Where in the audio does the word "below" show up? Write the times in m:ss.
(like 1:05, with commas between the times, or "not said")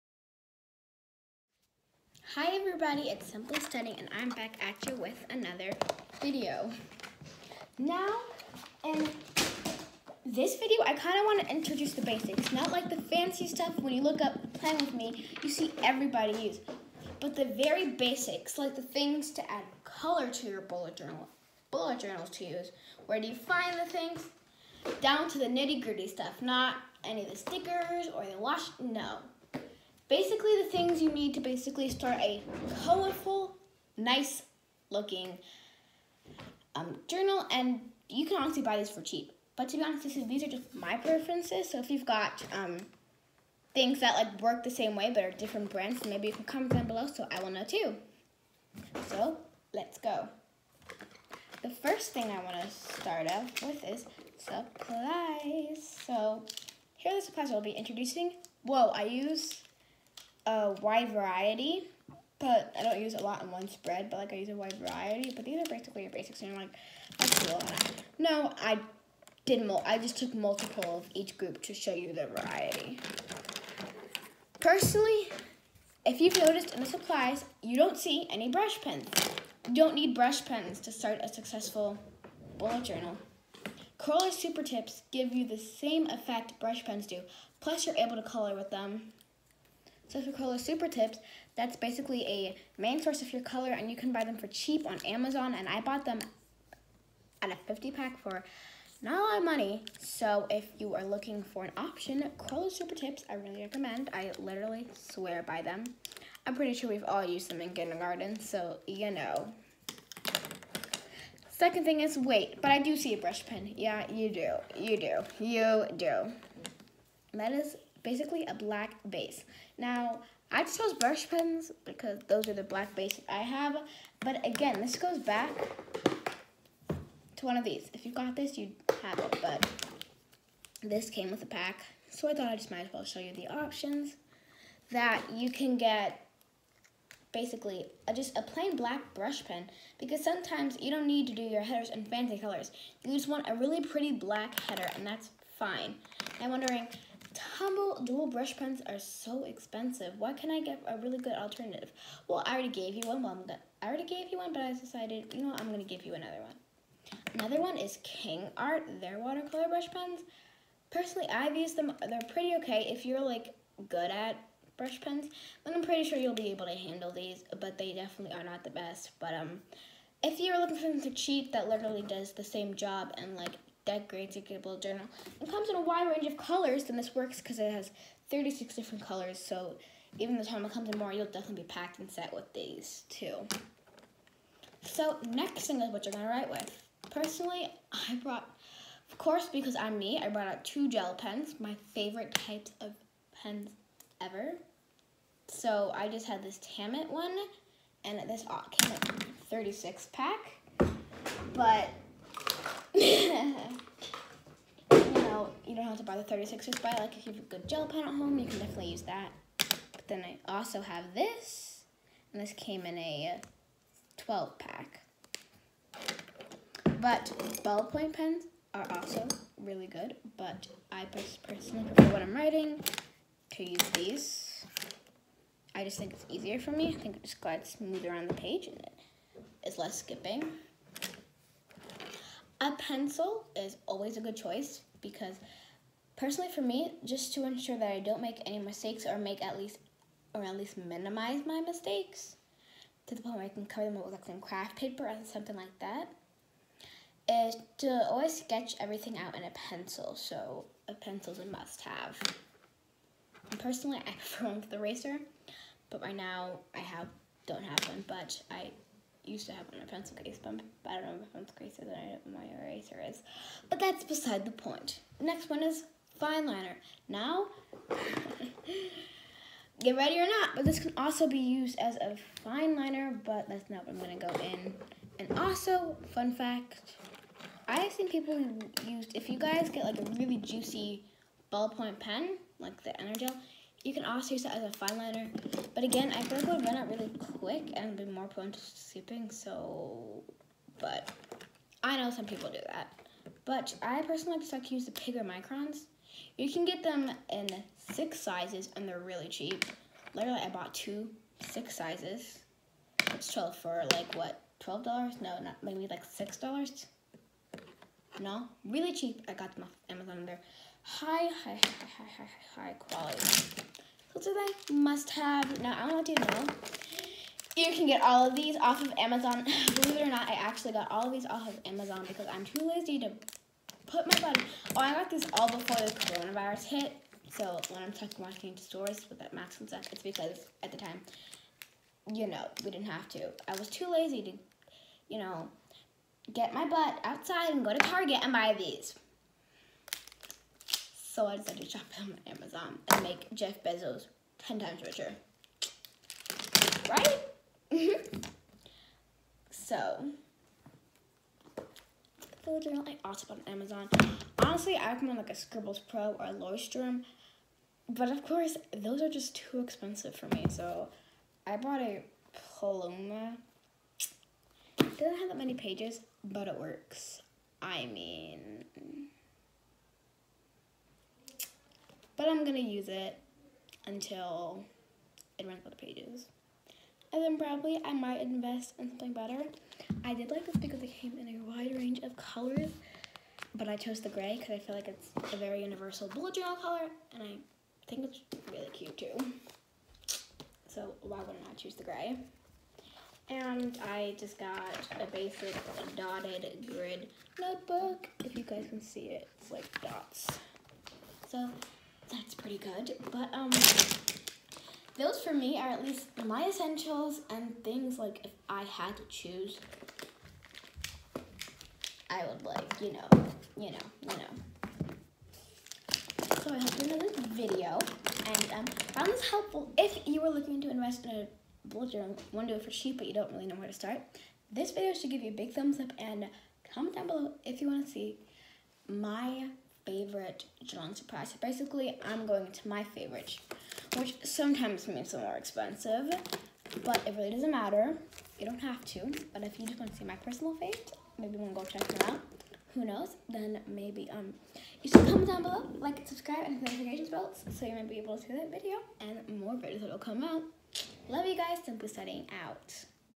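0:46, 7:07, 7:25.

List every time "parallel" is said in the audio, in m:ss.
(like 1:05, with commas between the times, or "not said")
not said.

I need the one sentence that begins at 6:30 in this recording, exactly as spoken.
So why wouldn't I choose the gray?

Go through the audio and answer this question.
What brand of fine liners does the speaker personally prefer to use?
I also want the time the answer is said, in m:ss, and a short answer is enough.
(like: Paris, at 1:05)
Microns, at 4:55.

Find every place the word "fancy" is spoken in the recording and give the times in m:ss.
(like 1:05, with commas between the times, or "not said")
0:13, 2:22.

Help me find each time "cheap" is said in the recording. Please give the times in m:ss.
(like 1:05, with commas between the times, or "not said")
0:39, 1:34, 2:51, 4:59, 5:08, 7:02.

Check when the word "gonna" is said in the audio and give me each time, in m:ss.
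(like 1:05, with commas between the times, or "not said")
2:33, 3:06, 4:34.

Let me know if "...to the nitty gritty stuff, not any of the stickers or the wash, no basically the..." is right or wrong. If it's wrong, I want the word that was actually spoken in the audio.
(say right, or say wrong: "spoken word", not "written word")
right.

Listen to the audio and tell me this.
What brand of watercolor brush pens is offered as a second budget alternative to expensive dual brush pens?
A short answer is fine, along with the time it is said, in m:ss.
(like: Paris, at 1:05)
King Art, at 2:38.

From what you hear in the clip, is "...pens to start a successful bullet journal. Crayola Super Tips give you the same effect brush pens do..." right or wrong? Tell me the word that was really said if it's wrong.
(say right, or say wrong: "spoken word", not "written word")
right.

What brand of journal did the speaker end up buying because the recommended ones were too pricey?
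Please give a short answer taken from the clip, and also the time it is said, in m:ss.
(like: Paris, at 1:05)
Paloma, at 6:02.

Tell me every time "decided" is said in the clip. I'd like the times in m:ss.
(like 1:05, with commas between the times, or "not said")
2:34, 5:41.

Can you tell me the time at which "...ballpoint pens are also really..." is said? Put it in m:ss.
3:37.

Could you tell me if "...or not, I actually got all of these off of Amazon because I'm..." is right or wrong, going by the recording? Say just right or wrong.
right.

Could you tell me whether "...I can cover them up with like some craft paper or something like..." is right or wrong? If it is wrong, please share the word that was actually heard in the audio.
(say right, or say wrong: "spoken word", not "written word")
right.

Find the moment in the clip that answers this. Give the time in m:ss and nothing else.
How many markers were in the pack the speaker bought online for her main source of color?
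1:37.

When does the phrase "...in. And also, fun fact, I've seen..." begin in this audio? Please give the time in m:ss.
4:34.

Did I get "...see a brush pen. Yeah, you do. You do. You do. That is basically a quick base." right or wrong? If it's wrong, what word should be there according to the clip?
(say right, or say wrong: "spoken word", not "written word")
wrong: "black", not "quick".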